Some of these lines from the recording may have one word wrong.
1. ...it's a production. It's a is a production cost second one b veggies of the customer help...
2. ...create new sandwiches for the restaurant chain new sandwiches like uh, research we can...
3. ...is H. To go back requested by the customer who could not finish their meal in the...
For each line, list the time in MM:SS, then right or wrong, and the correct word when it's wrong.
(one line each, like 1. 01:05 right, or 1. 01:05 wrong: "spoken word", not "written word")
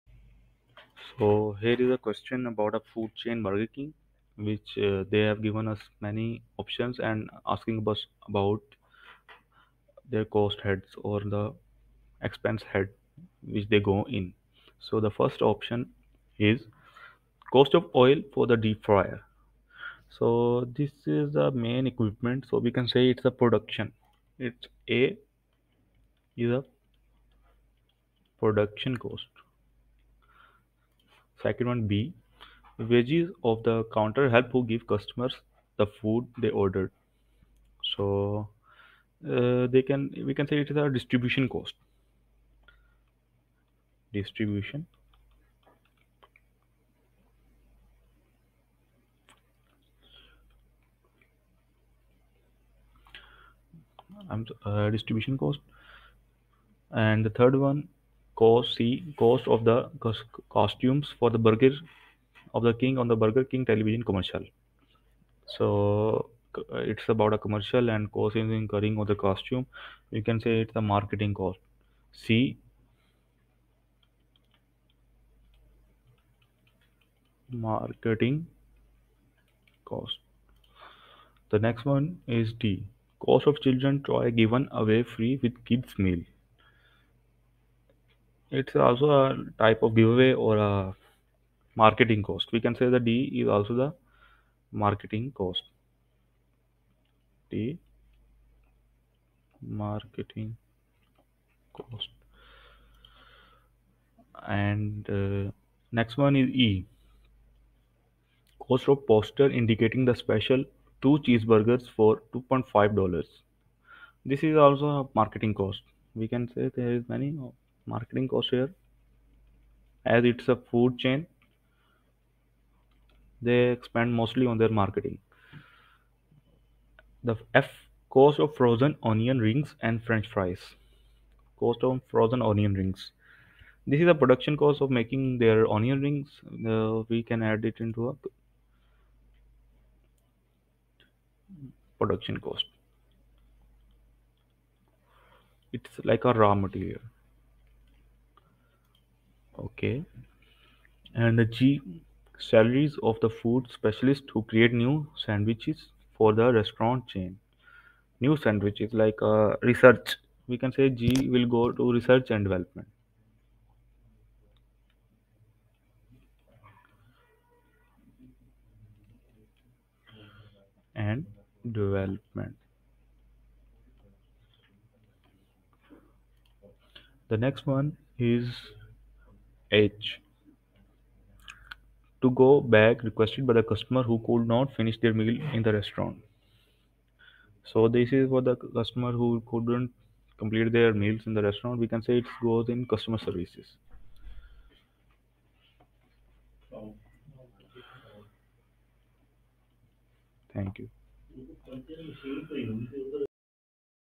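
1. 00:23 wrong: "counter", not "customer"
2. 02:34 right
3. 02:58 right.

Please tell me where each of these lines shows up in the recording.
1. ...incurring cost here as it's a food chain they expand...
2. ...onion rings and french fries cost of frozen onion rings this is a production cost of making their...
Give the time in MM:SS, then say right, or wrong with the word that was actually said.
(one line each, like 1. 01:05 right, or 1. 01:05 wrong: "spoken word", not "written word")
1. 01:57 wrong: "marketing", not "incurring"
2. 02:09 right.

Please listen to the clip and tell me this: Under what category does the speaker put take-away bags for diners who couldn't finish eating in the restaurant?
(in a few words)
Customer services.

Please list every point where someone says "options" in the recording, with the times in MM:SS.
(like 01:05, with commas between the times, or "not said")
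00:06, 00:15.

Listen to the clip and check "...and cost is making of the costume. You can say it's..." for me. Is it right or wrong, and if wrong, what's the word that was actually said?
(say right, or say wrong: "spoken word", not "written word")
wrong: "incurring", not "making".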